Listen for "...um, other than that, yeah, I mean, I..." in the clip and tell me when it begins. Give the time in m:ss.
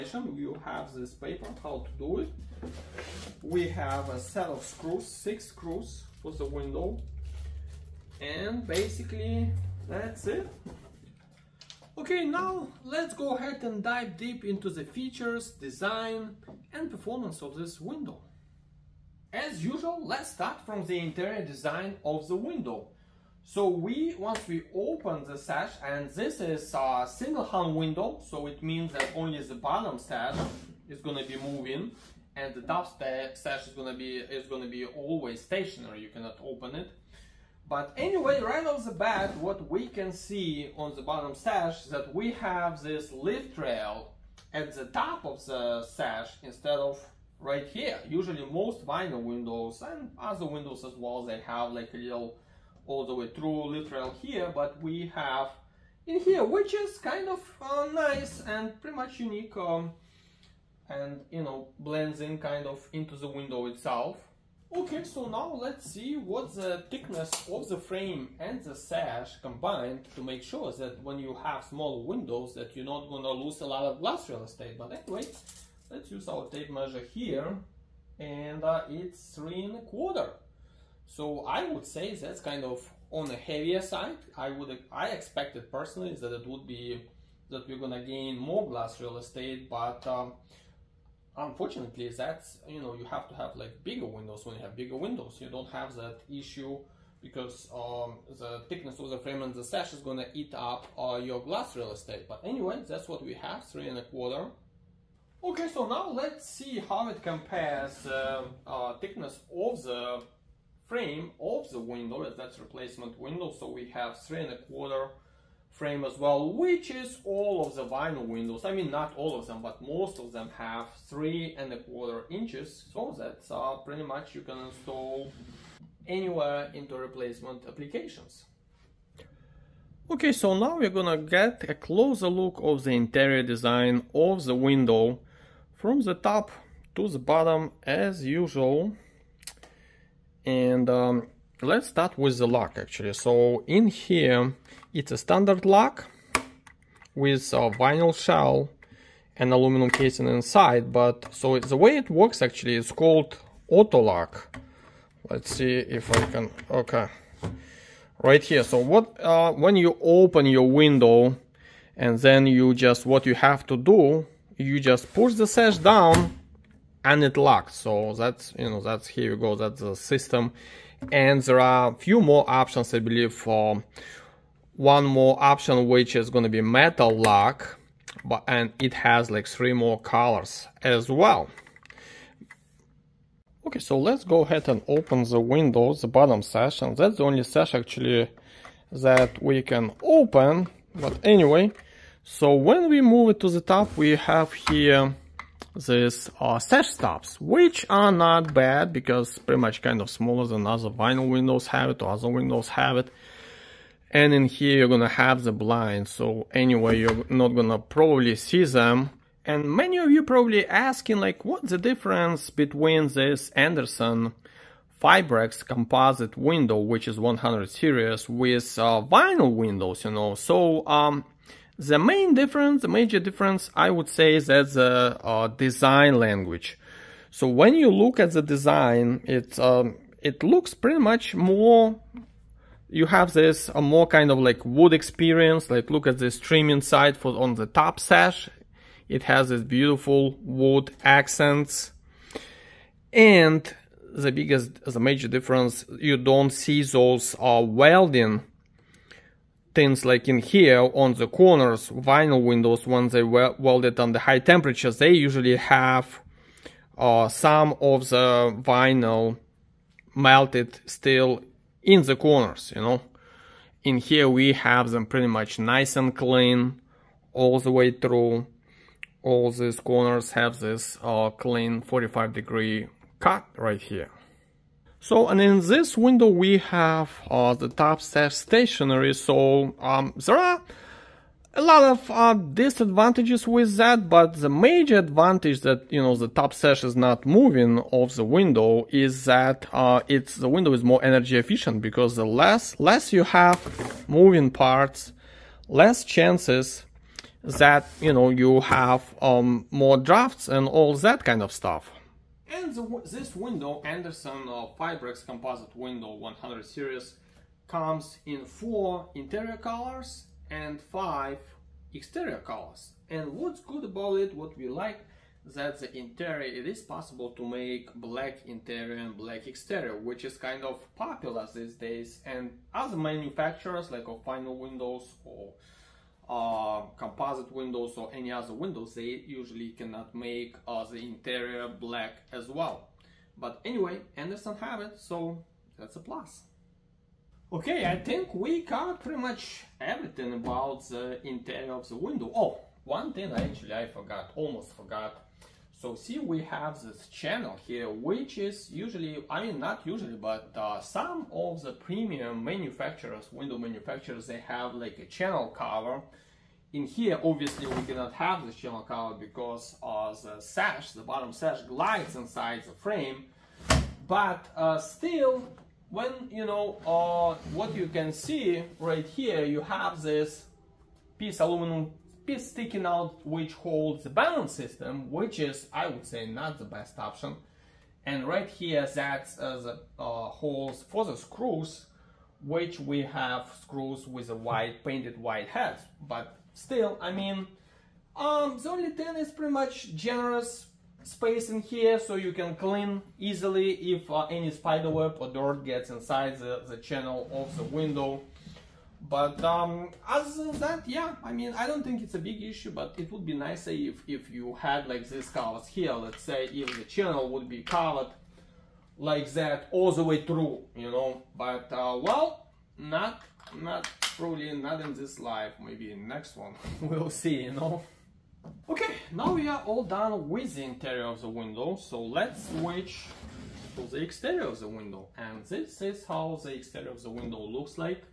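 6:39.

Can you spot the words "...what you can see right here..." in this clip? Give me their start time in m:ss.
6:07.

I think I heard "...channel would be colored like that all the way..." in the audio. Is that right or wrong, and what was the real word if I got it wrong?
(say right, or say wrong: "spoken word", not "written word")
right.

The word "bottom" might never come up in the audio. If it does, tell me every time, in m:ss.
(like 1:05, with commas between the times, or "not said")
0:29, 0:41, 2:17, 3:06, 6:01.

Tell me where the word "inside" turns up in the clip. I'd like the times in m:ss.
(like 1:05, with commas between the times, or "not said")
2:30, 6:02, 6:35.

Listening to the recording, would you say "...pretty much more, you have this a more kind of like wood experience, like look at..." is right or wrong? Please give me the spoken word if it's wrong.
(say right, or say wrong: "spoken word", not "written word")
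right.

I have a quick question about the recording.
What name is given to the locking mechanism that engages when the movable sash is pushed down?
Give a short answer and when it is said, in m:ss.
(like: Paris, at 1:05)
auto lock, at 2:33.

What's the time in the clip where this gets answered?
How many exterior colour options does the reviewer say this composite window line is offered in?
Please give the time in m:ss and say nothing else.
5:10.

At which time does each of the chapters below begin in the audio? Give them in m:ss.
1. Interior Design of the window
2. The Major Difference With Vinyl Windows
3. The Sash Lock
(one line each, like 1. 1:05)
1. 0:11
2. 3:30
3. 2:22.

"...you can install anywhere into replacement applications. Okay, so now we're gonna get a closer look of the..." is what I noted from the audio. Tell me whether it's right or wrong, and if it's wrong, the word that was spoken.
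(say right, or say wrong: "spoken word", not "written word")
right.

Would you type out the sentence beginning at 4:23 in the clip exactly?
In here we have them pretty much nice and clean all the way through.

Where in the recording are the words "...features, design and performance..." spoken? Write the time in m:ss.
0:14.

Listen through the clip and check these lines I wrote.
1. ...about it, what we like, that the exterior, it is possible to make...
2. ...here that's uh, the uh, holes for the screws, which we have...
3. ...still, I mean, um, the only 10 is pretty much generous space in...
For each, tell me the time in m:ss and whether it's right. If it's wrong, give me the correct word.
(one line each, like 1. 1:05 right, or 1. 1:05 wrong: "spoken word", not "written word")
1. 5:13 wrong: "interior", not "exterior"
2. 6:18 right
3. 6:26 right.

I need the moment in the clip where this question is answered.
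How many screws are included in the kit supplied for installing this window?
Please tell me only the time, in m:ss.
0:05.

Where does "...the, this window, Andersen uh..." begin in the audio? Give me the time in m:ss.
5:02.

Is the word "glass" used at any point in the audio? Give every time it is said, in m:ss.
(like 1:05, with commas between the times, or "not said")
1:13, 1:28, 1:41.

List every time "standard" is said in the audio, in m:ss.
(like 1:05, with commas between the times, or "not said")
2:25.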